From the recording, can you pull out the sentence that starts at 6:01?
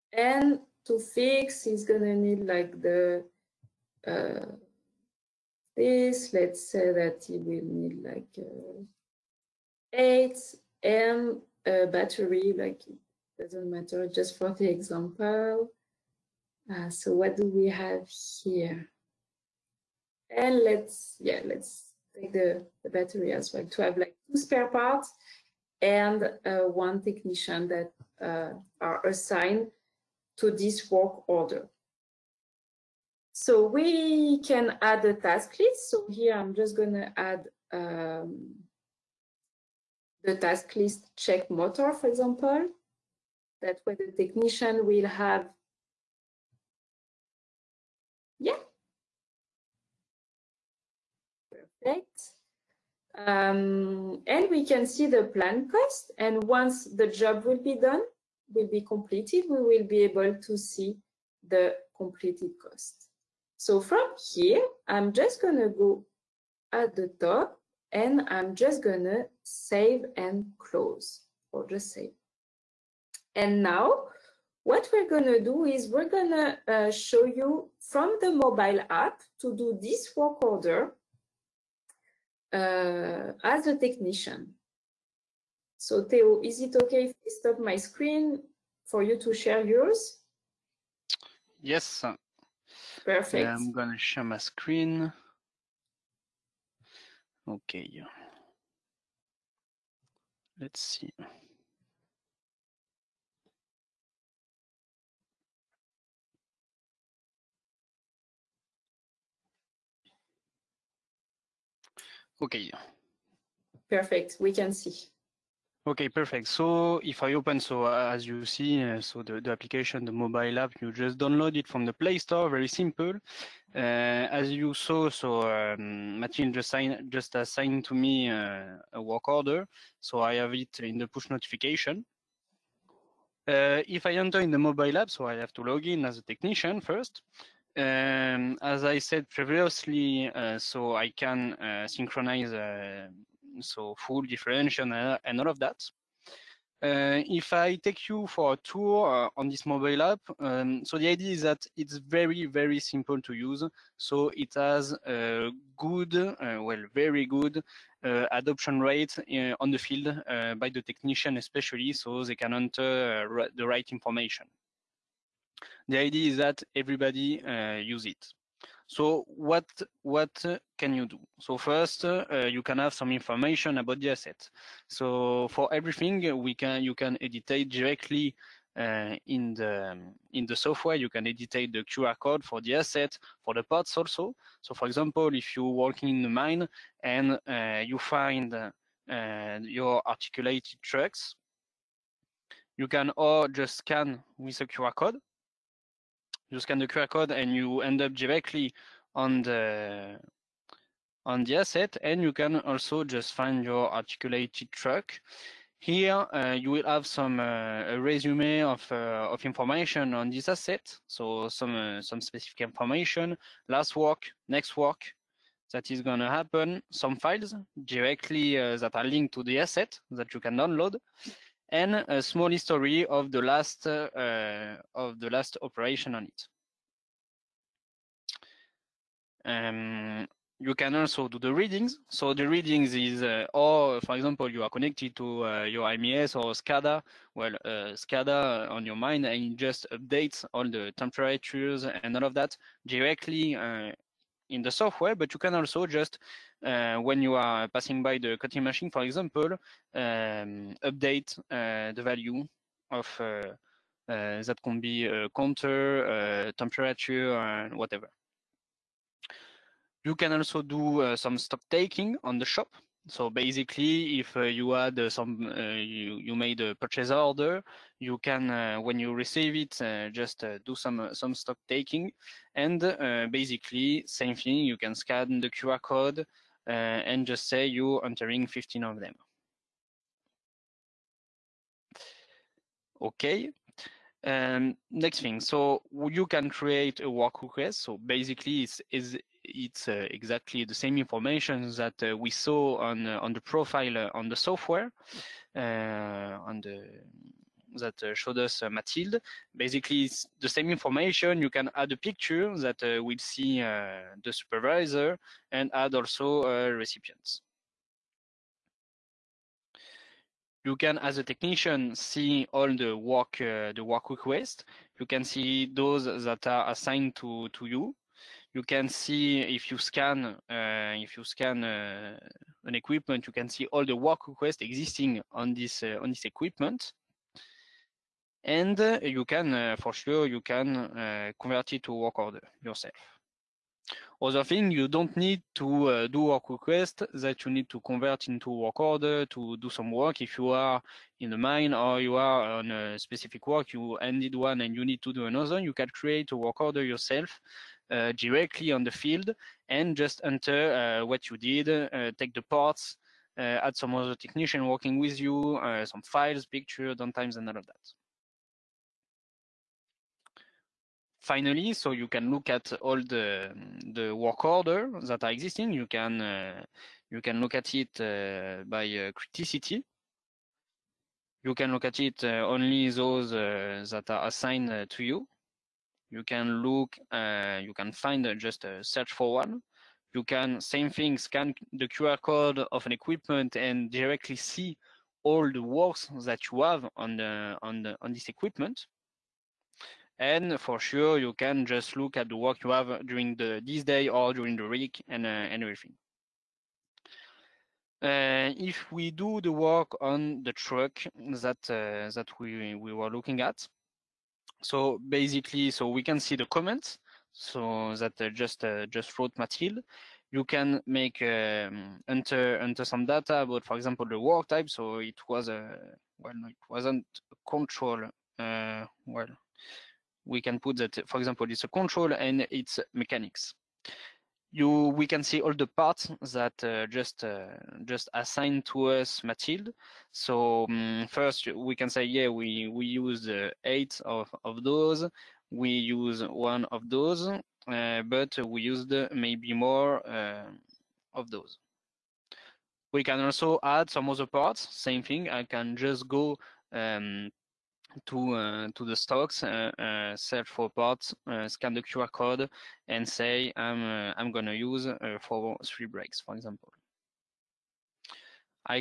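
Finally, so you can look at all the the work order that are existing.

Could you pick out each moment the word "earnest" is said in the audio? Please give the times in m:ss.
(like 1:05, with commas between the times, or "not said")
not said.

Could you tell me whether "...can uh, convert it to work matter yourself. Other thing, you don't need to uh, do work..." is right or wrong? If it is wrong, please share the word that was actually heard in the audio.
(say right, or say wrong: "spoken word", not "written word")
wrong: "order", not "matter".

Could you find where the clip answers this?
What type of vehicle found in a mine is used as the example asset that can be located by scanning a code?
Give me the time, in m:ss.
3:10.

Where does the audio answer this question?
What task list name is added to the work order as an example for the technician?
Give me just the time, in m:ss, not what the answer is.
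0:41.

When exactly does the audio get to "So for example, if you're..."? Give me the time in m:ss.
3:04.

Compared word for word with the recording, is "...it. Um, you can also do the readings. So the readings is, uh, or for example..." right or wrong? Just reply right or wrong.
right.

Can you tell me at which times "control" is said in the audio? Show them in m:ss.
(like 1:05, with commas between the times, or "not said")
6:57, 7:01.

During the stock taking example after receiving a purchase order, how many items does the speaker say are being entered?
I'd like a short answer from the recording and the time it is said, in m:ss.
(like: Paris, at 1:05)
15, at 4:38.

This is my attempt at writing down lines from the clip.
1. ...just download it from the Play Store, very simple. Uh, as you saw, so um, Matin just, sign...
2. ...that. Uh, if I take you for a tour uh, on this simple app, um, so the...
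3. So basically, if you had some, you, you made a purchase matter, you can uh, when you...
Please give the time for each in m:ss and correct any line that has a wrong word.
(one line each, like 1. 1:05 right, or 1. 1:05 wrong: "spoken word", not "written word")
1. 2:00 right
2. 2:25 wrong: "mobile", not "simple"
3. 4:23 wrong: "order", not "matter".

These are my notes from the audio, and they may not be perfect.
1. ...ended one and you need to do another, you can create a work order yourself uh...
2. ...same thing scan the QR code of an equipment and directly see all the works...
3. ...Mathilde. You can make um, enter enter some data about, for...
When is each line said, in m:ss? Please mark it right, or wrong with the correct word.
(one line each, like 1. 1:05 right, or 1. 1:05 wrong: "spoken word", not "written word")
1. 5:43 right
2. 6:20 right
3. 6:49 right.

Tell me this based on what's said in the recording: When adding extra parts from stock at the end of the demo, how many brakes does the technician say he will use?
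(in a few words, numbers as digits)
3.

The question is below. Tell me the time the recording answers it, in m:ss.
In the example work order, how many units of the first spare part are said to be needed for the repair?
0:09.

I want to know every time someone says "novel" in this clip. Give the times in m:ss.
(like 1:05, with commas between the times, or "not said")
not said.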